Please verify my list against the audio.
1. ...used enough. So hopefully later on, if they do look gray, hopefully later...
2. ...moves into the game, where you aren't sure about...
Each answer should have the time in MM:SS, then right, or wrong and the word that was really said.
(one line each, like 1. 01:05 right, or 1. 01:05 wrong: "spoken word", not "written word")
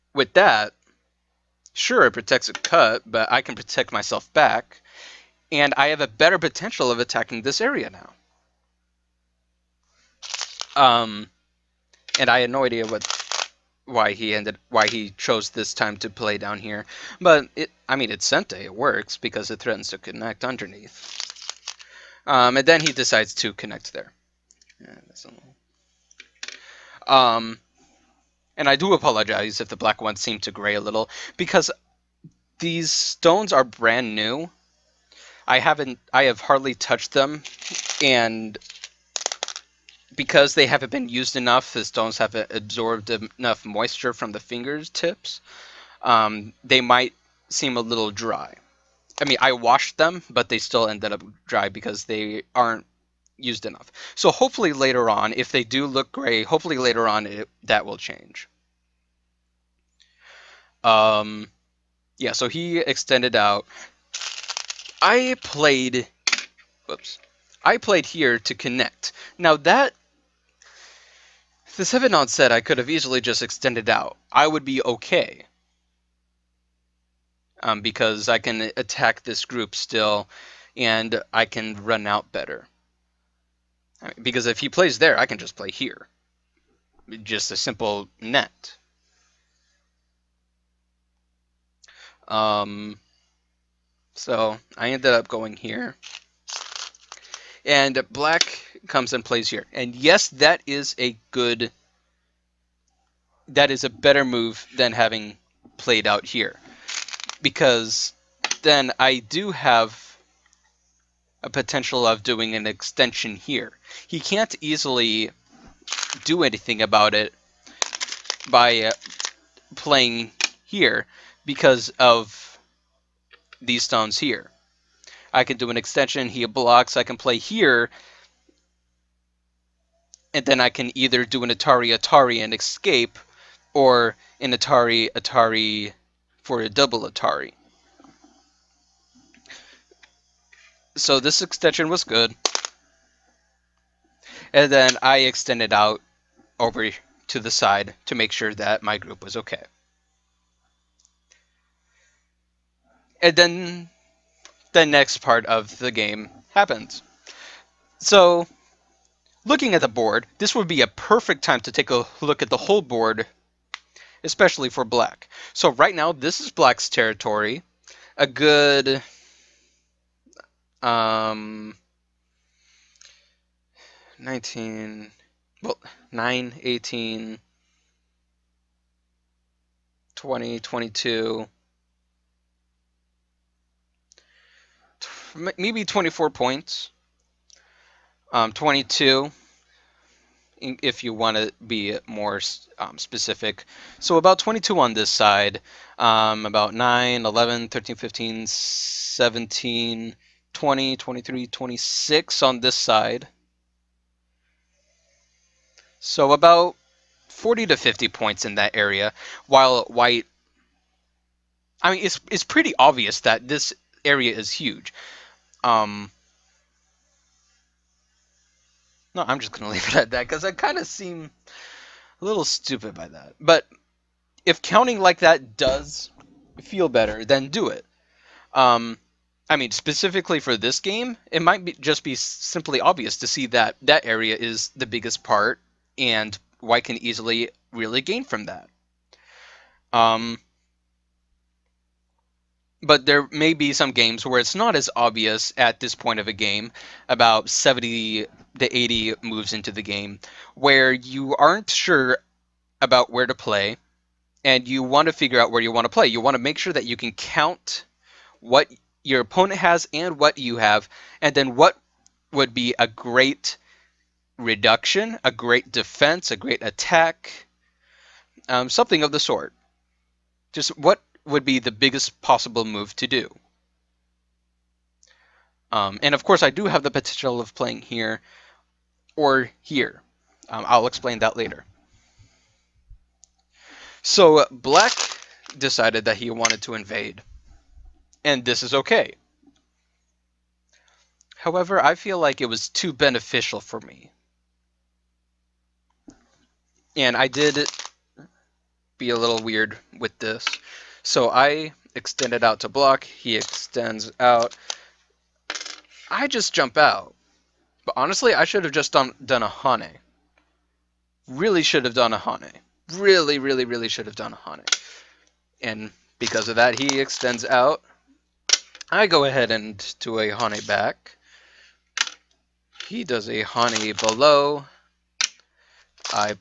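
1. 00:53 right
2. 04:09 right.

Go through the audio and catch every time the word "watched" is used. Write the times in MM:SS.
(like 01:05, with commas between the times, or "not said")
not said.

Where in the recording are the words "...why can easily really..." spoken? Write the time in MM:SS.
03:56.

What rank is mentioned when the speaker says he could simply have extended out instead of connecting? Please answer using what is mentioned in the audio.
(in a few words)
7 dan.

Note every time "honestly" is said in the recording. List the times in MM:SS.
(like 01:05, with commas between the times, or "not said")
05:07.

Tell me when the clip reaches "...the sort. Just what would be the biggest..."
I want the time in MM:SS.
04:29.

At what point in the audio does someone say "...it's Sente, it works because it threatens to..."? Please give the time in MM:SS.
00:18.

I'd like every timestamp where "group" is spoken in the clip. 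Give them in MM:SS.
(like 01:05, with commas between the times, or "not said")
01:19, 02:28.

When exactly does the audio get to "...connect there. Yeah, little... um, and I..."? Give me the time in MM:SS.
00:23.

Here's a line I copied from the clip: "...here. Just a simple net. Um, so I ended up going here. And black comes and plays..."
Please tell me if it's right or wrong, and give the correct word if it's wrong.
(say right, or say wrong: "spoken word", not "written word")
right.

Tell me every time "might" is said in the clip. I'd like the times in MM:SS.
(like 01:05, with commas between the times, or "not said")
00:46, 03:51.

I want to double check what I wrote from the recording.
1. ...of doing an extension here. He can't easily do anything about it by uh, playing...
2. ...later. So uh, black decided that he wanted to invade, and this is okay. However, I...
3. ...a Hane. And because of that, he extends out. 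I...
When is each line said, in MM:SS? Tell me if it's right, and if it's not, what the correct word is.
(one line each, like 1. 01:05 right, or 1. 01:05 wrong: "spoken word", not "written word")
1. 01:52 right
2. 04:41 right
3. 05:14 right.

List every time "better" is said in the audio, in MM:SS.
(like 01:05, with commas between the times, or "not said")
00:06, 01:22, 01:43, 03:46.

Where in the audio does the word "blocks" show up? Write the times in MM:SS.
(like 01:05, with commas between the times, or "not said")
02:06, 05:02.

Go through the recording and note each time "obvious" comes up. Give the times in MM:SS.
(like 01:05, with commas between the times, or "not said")
03:32, 03:52, 04:04.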